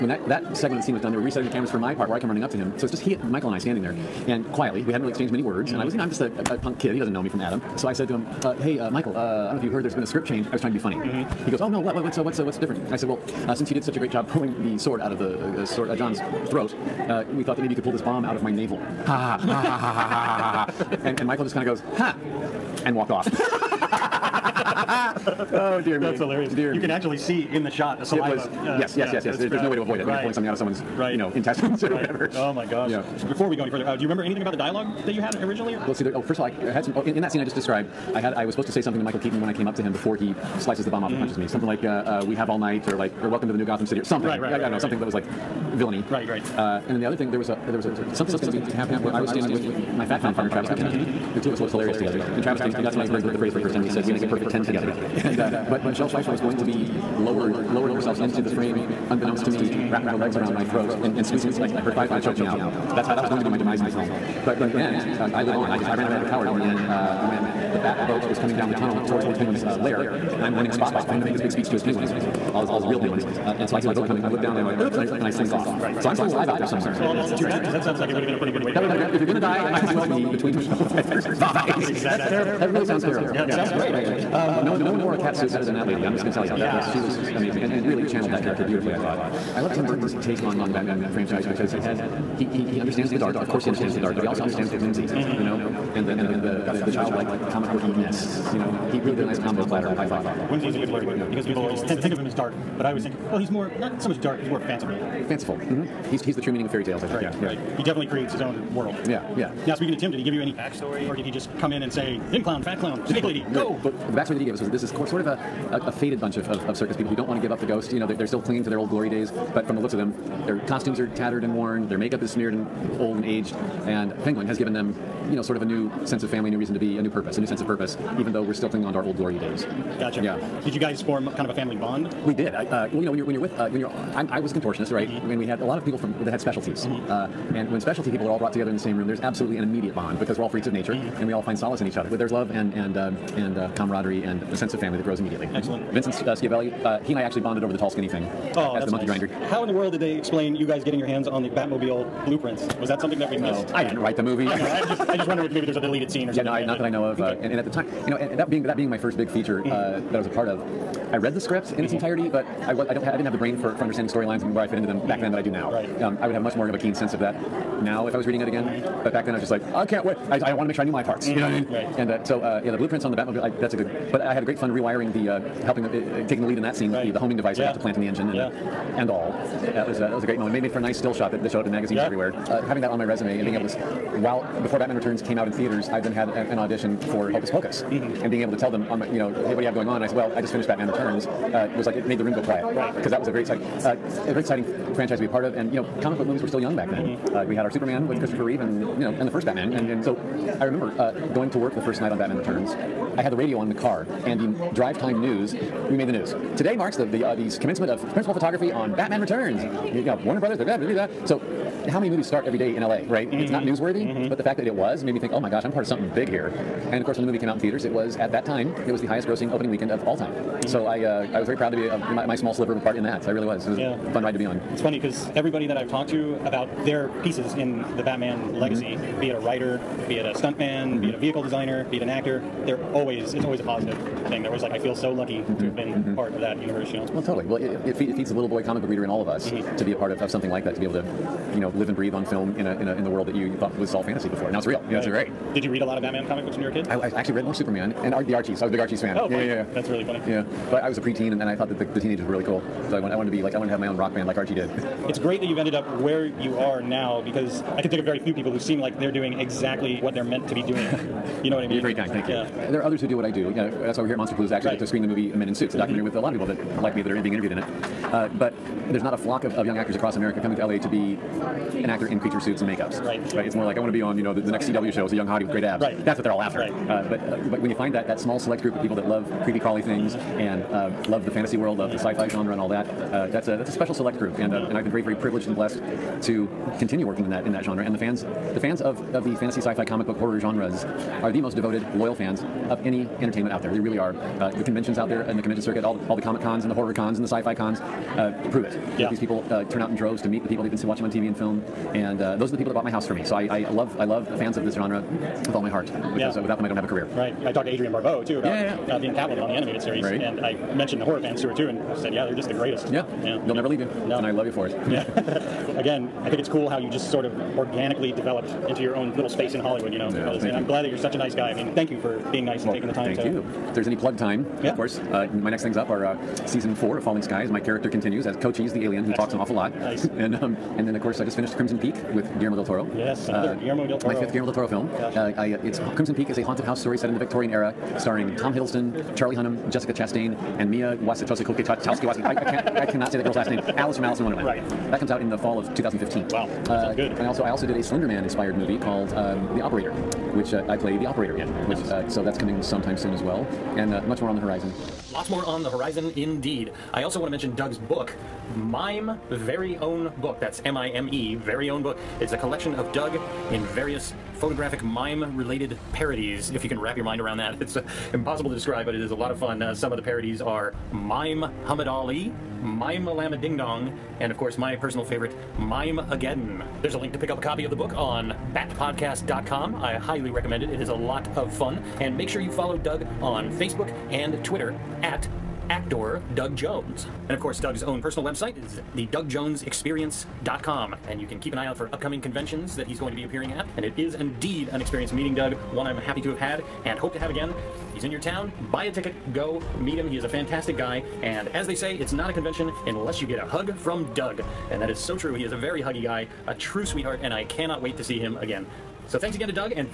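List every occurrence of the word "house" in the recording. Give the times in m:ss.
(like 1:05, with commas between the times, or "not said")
5:02, 5:36.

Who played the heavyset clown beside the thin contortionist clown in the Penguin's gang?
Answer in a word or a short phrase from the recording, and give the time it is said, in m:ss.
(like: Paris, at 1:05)
Travis McKenna, at 0:50.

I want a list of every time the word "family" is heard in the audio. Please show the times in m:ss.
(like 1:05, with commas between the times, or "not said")
2:06, 2:11, 2:24.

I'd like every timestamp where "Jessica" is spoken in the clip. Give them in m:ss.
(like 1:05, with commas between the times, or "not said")
5:39.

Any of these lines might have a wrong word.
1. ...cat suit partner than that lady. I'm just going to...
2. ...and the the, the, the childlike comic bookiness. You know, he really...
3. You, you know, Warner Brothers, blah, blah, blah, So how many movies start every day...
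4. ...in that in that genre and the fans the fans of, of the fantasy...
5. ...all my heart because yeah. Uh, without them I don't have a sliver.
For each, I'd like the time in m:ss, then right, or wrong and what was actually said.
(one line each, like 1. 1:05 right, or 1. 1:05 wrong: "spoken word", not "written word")
1. 1:25 wrong: "better", not "partner"
2. 1:36 right
3. 3:29 right
4. 4:47 right
5. 5:05 wrong: "career", not "sliver".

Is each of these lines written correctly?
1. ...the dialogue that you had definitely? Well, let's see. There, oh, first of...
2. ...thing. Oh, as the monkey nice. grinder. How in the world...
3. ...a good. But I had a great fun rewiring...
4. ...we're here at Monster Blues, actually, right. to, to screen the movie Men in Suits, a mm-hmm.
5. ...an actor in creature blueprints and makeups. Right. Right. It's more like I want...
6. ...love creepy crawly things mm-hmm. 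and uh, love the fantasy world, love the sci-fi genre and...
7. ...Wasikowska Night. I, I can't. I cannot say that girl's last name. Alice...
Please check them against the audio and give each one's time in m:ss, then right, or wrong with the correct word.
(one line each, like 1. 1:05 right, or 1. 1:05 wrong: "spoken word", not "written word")
1. 0:34 wrong: "originally", not "definitely"
2. 2:28 right
3. 2:53 right
4. 4:24 right
5. 4:31 wrong: "suits", not "blueprints"
6. 4:39 right
7. 5:41 wrong: "Kachowski", not "Night".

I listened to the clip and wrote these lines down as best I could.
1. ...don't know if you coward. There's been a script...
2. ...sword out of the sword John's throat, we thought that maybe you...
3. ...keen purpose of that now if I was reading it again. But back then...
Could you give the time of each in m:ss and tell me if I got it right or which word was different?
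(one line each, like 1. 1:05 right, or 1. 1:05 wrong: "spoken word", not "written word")
1. 0:09 wrong: "heard", not "coward"
2. 0:14 right
3. 2:46 wrong: "sense", not "purpose".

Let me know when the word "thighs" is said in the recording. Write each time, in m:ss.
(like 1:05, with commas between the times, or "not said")
1:01, 1:21.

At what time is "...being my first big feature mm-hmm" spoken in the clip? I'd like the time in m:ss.
2:38.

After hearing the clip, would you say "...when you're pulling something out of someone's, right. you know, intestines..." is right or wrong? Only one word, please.
right.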